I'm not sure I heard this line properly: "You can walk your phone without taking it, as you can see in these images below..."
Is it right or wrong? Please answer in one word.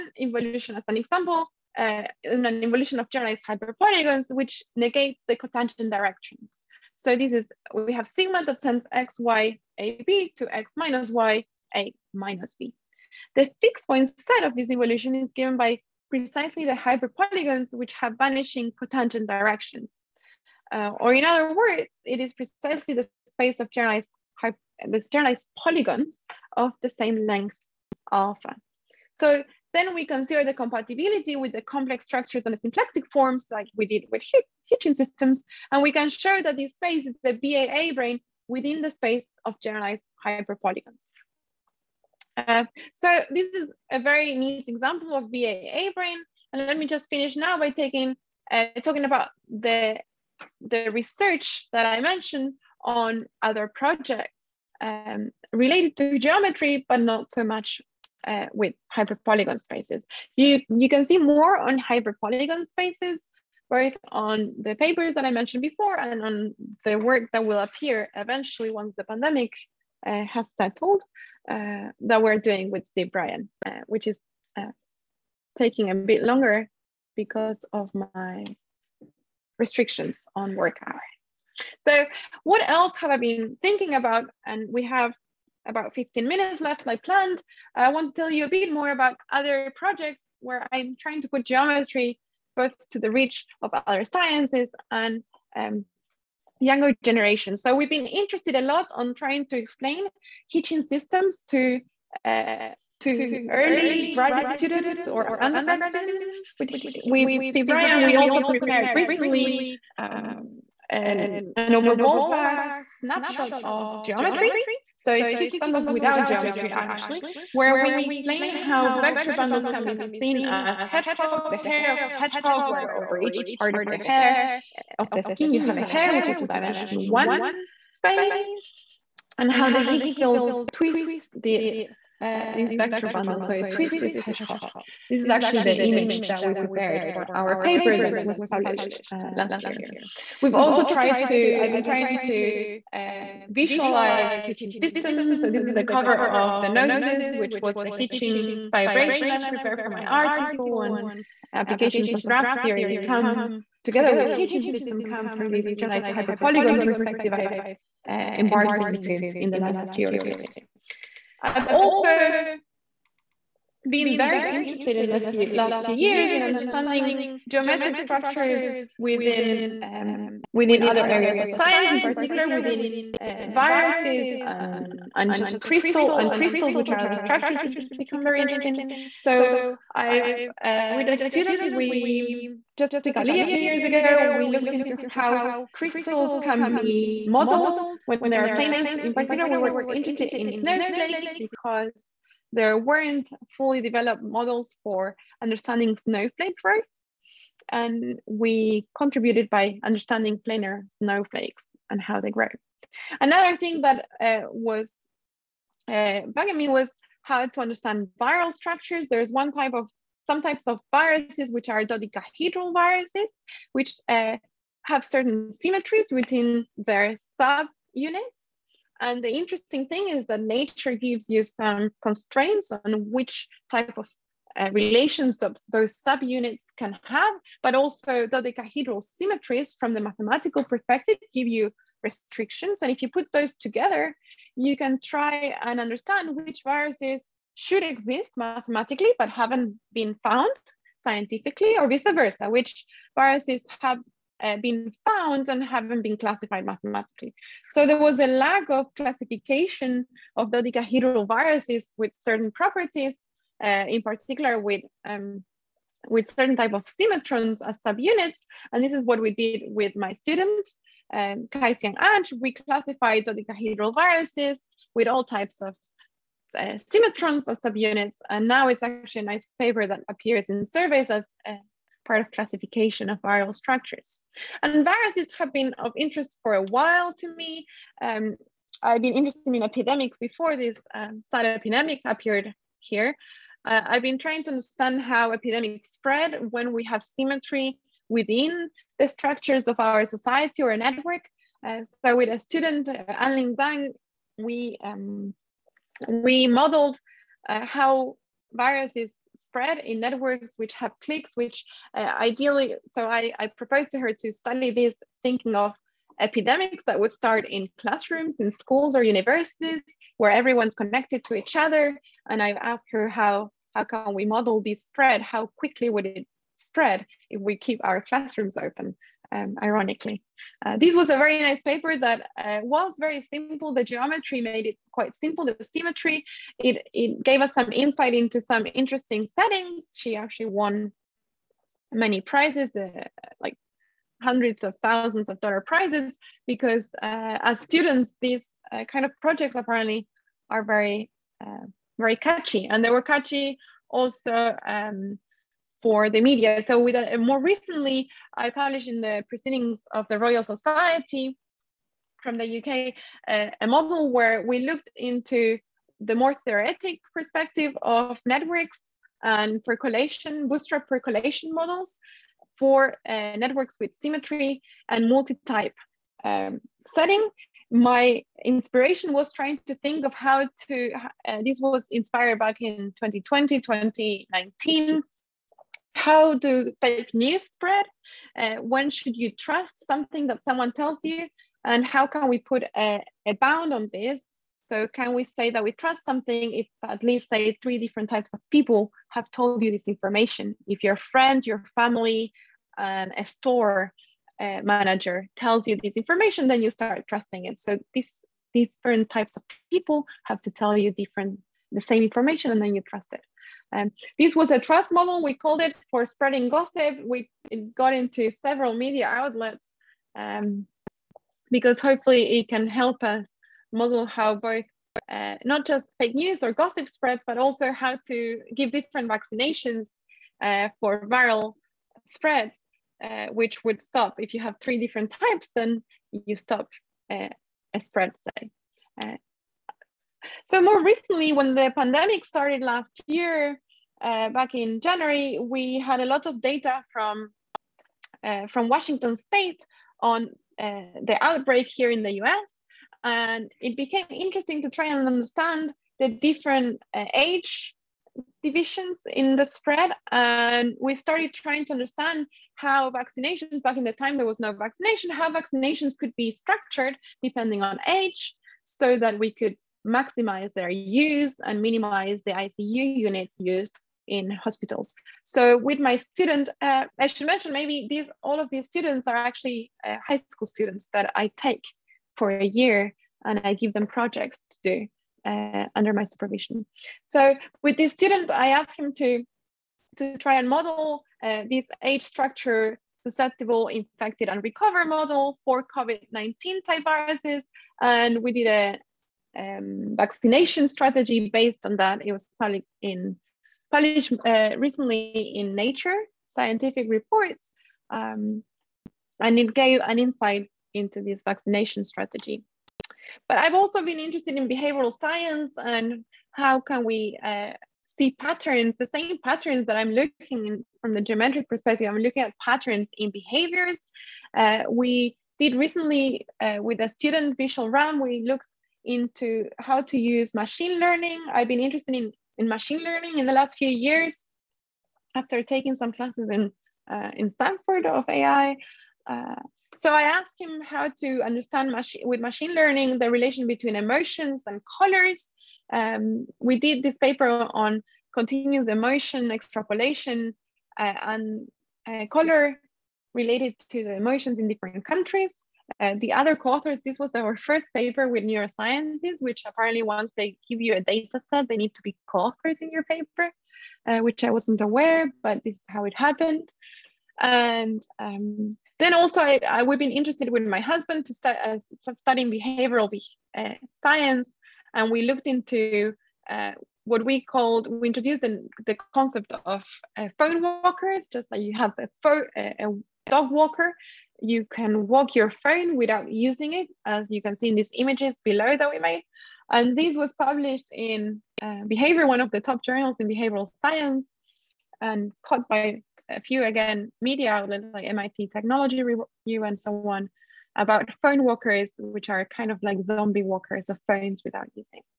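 wrong.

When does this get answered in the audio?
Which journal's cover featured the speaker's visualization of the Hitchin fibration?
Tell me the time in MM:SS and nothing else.
02:26.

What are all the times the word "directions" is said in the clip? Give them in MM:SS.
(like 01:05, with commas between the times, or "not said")
00:05, 00:19.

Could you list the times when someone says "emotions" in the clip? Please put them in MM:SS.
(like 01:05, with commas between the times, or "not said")
08:53, 08:58, 09:03.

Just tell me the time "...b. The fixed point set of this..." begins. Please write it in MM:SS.
00:12.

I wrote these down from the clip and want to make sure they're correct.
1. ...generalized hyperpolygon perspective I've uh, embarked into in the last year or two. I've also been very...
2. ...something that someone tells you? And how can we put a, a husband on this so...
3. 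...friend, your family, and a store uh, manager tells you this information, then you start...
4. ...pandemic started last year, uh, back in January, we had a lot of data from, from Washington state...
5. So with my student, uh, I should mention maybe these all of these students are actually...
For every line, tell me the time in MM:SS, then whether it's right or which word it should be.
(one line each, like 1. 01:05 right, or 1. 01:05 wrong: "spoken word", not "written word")
1. 02:35 right
2. 06:19 wrong: "bound", not "husband"
3. 06:30 right
4. 07:11 right
5. 07:45 right.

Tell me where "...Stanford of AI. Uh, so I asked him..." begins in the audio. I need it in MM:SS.
08:47.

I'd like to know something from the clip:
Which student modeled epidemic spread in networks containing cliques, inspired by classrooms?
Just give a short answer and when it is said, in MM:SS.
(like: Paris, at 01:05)
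Anling Zhang, at 04:53.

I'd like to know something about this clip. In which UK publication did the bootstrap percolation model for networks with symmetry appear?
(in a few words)
Proceedings of the Royal Society.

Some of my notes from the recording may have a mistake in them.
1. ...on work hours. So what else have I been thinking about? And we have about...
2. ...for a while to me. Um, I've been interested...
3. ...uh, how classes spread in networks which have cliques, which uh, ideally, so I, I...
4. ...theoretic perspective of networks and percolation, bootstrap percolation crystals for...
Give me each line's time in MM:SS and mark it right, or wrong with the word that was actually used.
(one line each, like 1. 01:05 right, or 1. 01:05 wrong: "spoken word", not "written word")
1. 01:20 right
2. 04:36 right
3. 04:57 wrong: "viruses", not "classes"
4. 05:56 wrong: "models", not "crystals".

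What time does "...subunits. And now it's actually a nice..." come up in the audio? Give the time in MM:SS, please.
04:27.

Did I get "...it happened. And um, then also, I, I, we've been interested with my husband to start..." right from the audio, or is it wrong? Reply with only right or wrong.
right.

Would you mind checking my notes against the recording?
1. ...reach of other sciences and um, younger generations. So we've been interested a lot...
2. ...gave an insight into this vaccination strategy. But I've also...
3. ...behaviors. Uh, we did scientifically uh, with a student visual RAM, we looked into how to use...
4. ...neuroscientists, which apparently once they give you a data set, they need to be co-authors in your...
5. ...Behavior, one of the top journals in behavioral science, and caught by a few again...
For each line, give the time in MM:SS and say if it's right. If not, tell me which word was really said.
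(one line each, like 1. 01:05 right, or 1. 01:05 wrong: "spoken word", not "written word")
1. 01:33 right
2. 08:19 right
3. 08:33 wrong: "recently", not "scientifically"
4. 09:08 right
5. 09:41 right.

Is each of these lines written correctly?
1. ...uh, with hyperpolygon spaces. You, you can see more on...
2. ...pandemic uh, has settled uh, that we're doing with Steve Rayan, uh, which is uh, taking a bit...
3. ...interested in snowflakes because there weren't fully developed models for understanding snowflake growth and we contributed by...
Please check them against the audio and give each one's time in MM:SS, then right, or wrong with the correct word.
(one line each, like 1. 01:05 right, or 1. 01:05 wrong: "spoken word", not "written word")
1. 00:58 right
2. 01:09 right
3. 03:09 right.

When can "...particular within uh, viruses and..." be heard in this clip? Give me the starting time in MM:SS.
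02:51.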